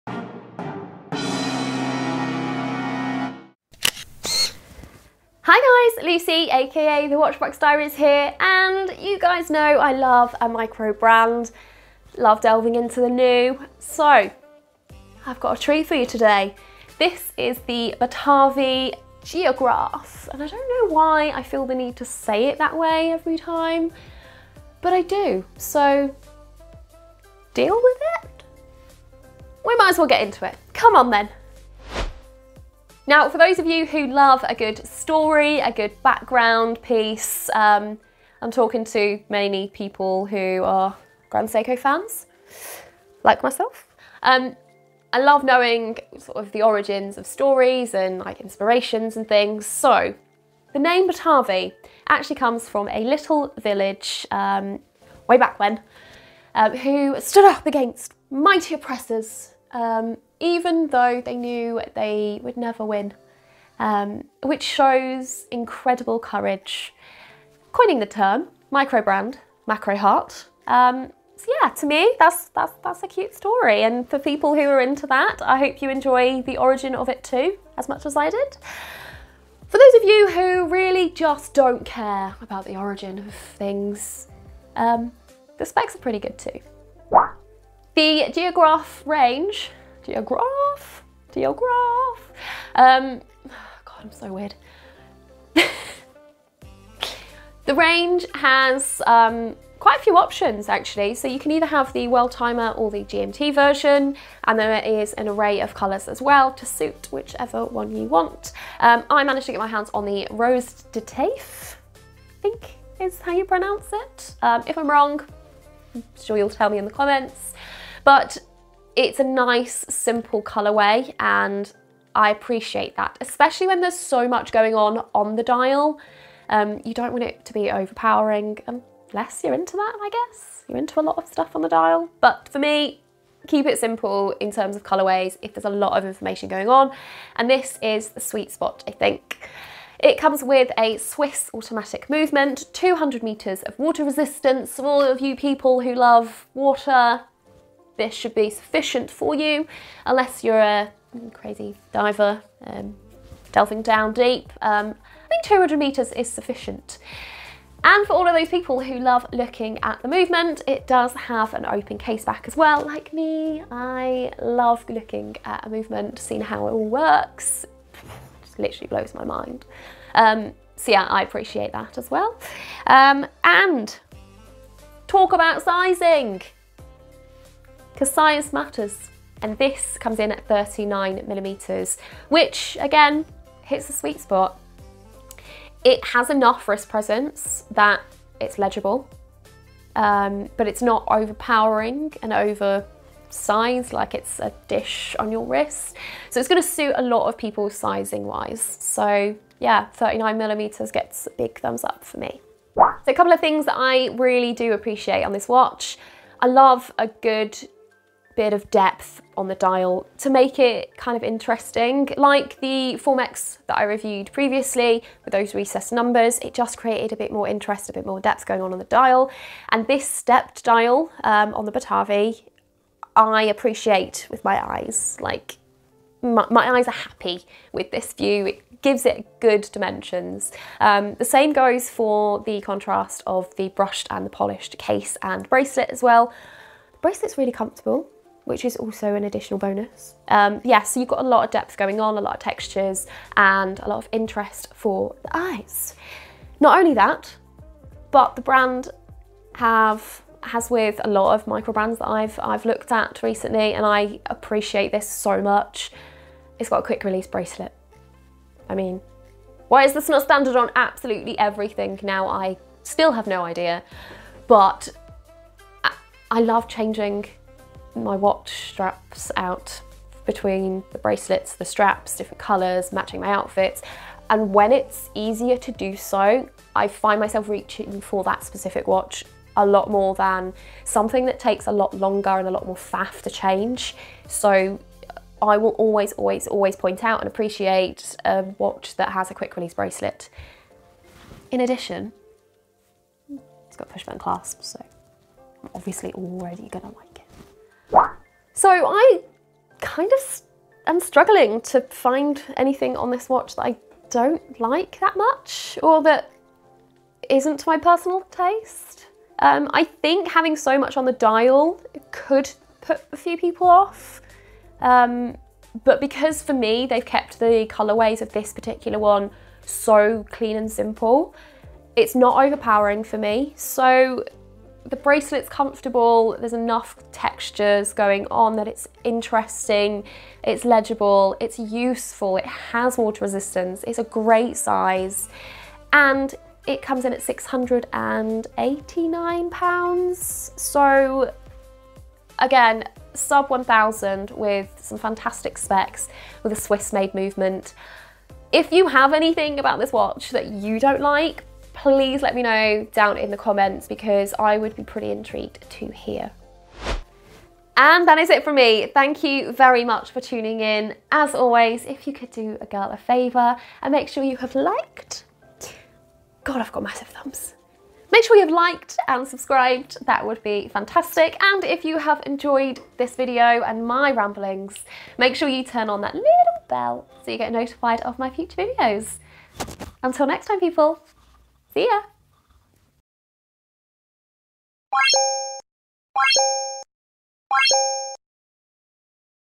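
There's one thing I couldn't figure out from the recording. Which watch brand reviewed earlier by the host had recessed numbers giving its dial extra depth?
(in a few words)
Formex.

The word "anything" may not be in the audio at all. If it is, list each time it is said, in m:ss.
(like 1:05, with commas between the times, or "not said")
5:02, 5:49.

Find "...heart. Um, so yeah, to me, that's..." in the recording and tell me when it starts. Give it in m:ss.
1:09.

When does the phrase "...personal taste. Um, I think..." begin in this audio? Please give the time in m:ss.
5:07.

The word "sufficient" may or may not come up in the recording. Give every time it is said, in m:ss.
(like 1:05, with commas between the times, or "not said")
2:28, 2:36.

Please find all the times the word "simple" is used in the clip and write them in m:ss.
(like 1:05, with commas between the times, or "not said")
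1:59, 2:13, 5:20.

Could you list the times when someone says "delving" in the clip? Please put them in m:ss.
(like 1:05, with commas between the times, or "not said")
0:12, 2:33.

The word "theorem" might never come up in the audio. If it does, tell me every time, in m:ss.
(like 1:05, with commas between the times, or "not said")
not said.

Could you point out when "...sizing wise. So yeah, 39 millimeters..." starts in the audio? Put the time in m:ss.
3:17.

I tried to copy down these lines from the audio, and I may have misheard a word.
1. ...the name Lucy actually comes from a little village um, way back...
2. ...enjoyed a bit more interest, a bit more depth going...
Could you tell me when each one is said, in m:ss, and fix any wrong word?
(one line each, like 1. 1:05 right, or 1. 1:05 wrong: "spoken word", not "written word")
1. 0:50 wrong: "Batavi", not "Lucy"
2. 3:36 wrong: "created", not "enjoyed".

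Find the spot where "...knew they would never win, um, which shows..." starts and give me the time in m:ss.
1:01.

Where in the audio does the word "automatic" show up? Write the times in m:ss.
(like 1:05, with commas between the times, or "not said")
2:21.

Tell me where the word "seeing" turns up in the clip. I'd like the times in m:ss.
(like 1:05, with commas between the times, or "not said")
2:46.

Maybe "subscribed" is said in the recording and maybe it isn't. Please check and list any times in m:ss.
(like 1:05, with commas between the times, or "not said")
6:09.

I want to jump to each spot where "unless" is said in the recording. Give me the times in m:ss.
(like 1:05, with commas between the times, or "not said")
2:09, 2:30.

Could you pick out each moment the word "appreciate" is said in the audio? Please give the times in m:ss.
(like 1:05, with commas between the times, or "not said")
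2:02, 2:51, 3:24, 3:43, 4:14, 4:47.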